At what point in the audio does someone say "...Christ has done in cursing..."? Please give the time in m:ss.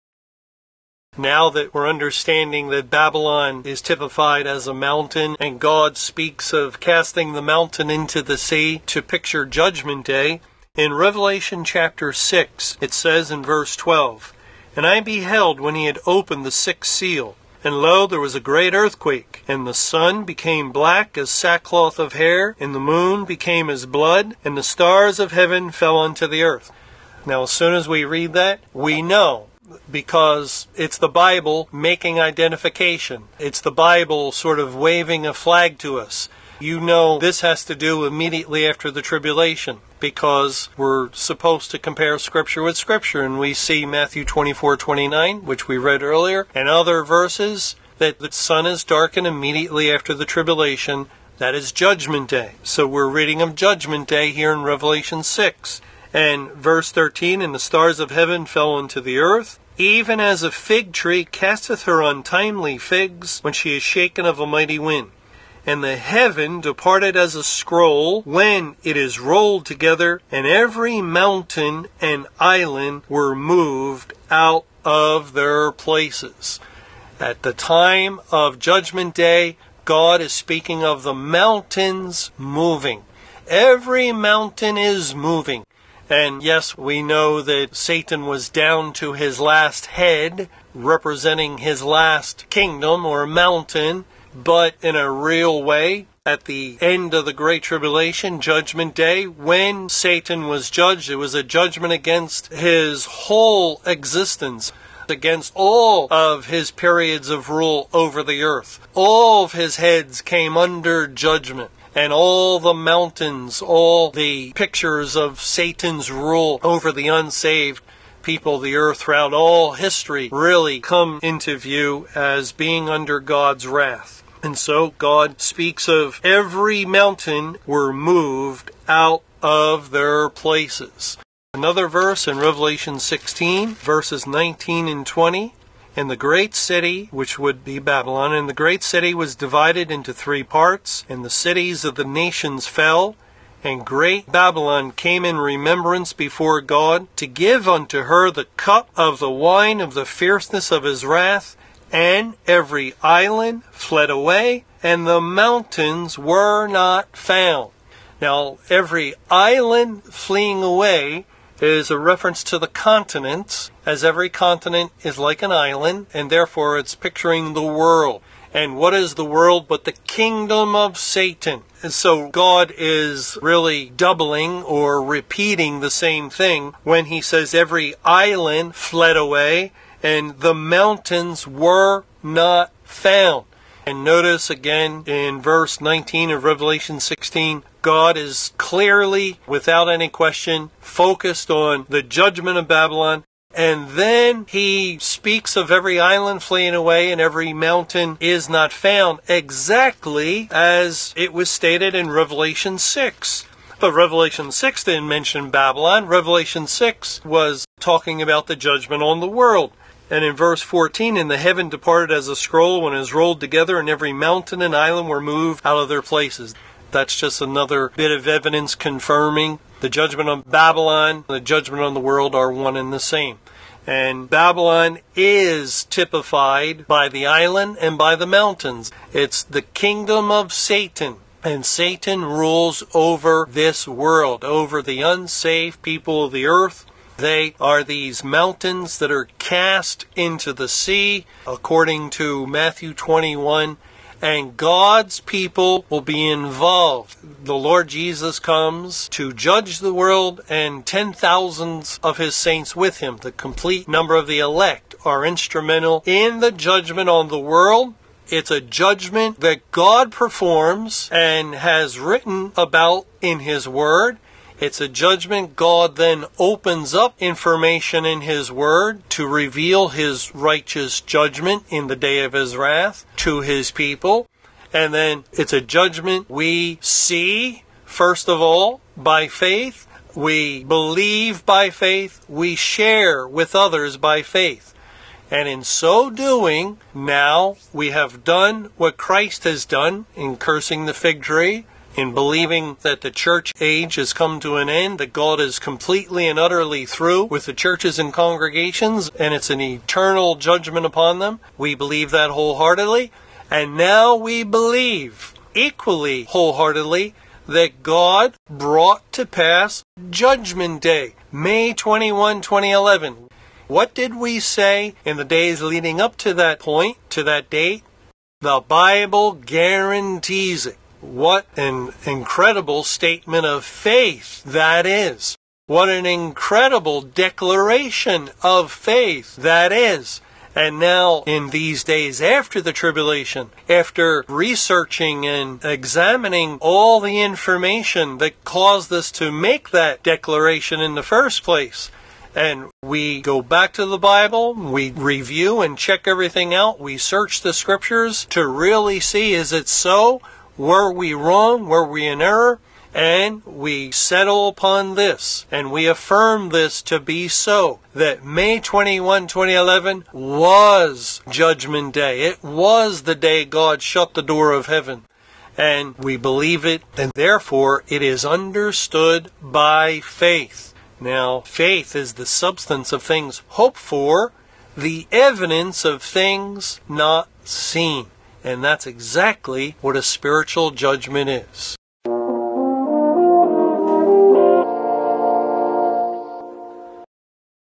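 4:48.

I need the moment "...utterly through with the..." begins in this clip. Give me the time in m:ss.
4:56.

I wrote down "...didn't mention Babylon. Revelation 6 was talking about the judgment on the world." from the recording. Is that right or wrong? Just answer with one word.
right.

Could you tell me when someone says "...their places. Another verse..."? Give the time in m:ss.
2:09.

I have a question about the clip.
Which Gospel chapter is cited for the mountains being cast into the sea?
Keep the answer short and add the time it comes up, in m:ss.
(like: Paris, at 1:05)
Matthew 21, at 4:02.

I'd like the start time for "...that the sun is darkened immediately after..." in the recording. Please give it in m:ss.
0:47.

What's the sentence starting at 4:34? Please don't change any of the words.
And then it's a judgment we see, first of all, by faith.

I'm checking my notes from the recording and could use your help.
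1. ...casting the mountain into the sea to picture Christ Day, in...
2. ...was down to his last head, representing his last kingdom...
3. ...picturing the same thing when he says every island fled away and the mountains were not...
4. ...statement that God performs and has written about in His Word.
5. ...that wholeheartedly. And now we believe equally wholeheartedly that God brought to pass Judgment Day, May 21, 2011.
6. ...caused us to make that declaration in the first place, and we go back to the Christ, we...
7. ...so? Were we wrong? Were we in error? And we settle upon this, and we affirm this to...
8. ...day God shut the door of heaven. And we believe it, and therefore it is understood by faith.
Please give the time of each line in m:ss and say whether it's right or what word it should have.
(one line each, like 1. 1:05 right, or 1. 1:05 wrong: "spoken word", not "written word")
1. 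0:06 wrong: "Judgment", not "Christ"
2. 1:28 right
3. 2:55 wrong: "repeating", not "picturing"
4. 4:18 wrong: "judgment", not "statement"
5. 5:02 right
6. 5:38 wrong: "Bible", not "Christ"
7. 5:49 right
8. 6:03 right.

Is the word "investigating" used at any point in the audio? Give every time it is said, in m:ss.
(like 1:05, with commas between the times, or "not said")
not said.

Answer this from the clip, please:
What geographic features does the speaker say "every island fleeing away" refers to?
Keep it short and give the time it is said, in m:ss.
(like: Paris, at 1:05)
continents, at 2:42.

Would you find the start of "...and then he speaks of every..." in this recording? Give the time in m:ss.
3:13.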